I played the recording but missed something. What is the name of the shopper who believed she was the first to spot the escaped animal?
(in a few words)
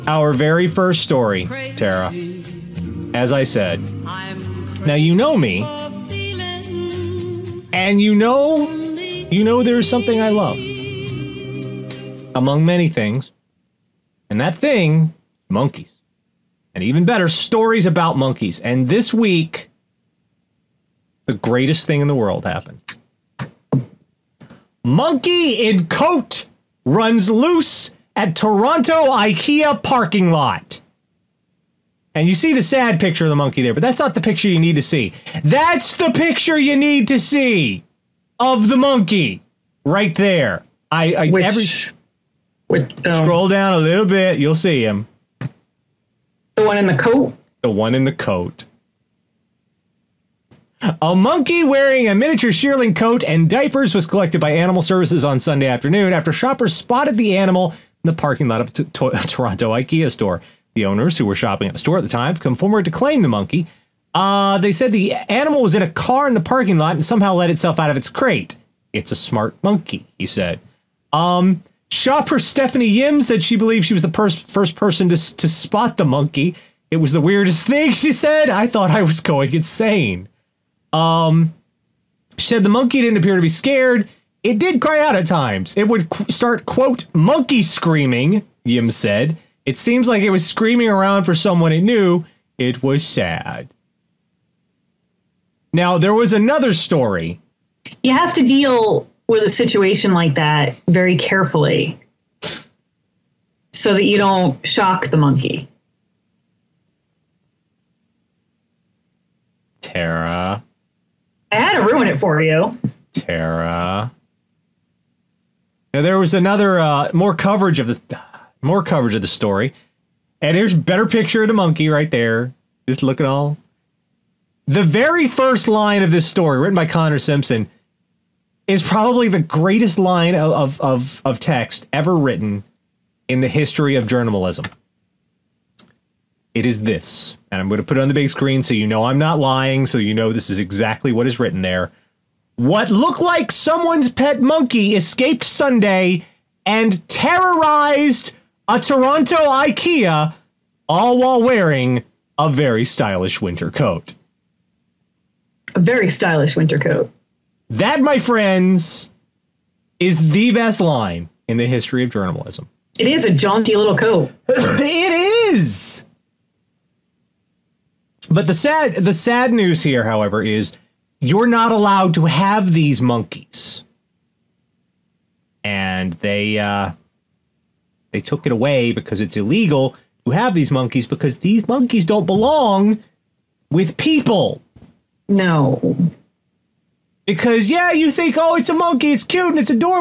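Stephanie Yim.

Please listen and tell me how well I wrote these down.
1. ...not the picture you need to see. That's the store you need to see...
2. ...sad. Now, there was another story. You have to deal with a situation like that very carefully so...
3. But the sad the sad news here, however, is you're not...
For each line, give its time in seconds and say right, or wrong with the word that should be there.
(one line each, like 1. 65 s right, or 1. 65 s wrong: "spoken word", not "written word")
1. 33 s wrong: "picture", not "store"
2. 93 s right
3. 168 s right.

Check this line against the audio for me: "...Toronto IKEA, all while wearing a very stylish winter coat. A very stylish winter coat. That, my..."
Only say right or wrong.
right.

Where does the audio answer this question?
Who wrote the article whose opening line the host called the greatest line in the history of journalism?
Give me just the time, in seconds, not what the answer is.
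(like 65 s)
126 s.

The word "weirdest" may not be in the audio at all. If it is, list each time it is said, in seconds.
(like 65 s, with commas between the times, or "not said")
77 s.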